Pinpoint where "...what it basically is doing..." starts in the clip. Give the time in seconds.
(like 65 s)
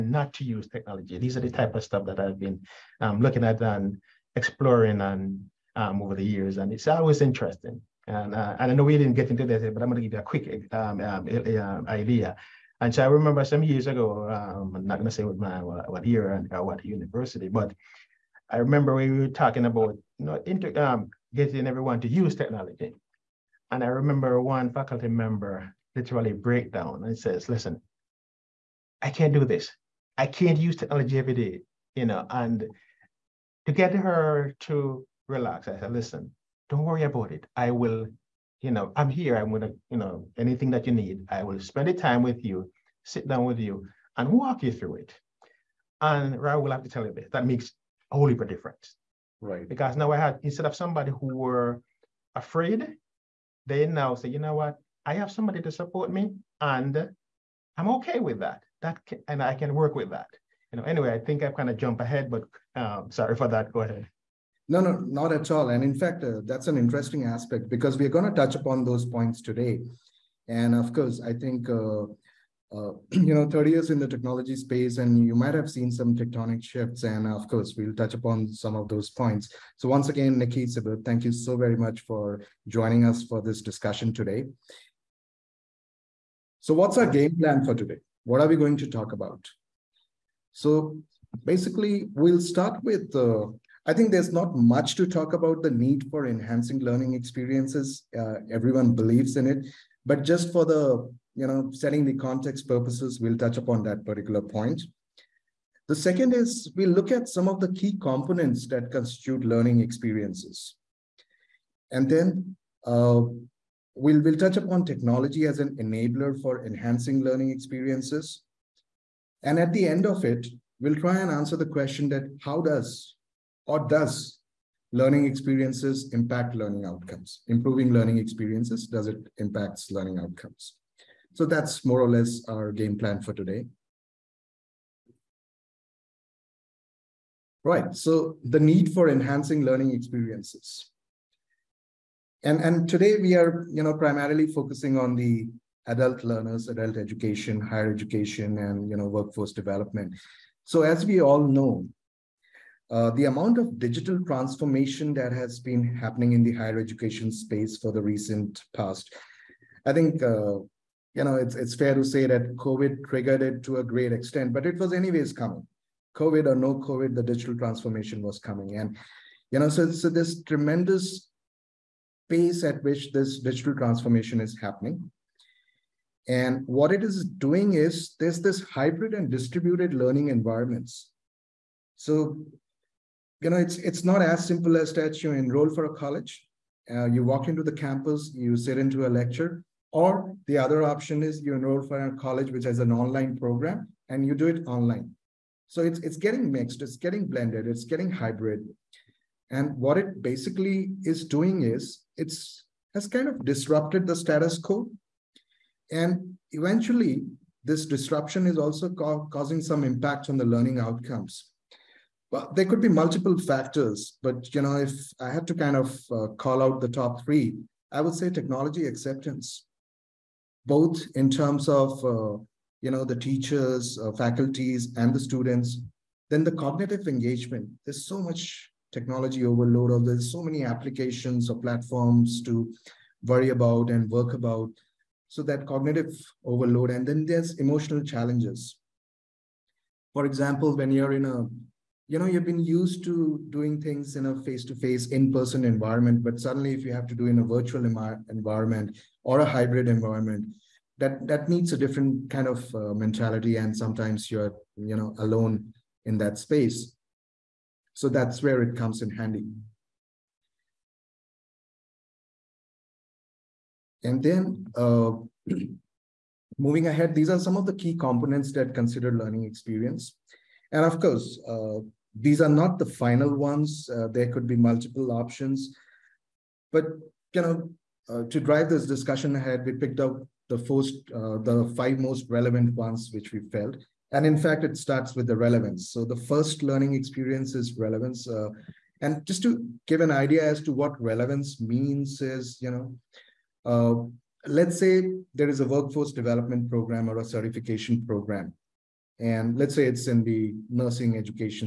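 199 s.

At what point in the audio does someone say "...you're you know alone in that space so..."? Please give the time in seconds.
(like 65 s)
254 s.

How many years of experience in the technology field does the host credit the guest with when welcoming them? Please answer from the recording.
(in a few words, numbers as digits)
30 years.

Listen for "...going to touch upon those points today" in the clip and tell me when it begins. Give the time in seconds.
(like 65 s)
68 s.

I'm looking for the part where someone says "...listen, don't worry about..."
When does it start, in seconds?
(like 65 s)
35 s.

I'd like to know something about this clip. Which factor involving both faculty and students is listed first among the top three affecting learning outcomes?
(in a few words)
technology acceptance.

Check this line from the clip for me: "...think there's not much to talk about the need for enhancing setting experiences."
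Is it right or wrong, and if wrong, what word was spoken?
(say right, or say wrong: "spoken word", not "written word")
wrong: "learning", not "setting".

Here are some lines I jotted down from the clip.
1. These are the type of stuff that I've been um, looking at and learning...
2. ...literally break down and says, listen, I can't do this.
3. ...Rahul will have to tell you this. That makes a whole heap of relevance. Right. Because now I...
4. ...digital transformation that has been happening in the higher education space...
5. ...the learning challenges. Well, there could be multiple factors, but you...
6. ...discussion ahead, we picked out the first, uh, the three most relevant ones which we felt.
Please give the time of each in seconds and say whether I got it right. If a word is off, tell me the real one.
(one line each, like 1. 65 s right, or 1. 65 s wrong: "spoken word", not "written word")
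1. 1 s wrong: "exploring", not "learning"
2. 25 s right
3. 46 s wrong: "difference", not "relevance"
4. 153 s right
5. 210 s wrong: "outcomes", not "challenges"
6. 278 s wrong: "five", not "three".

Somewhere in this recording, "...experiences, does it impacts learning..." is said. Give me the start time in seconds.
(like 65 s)
128 s.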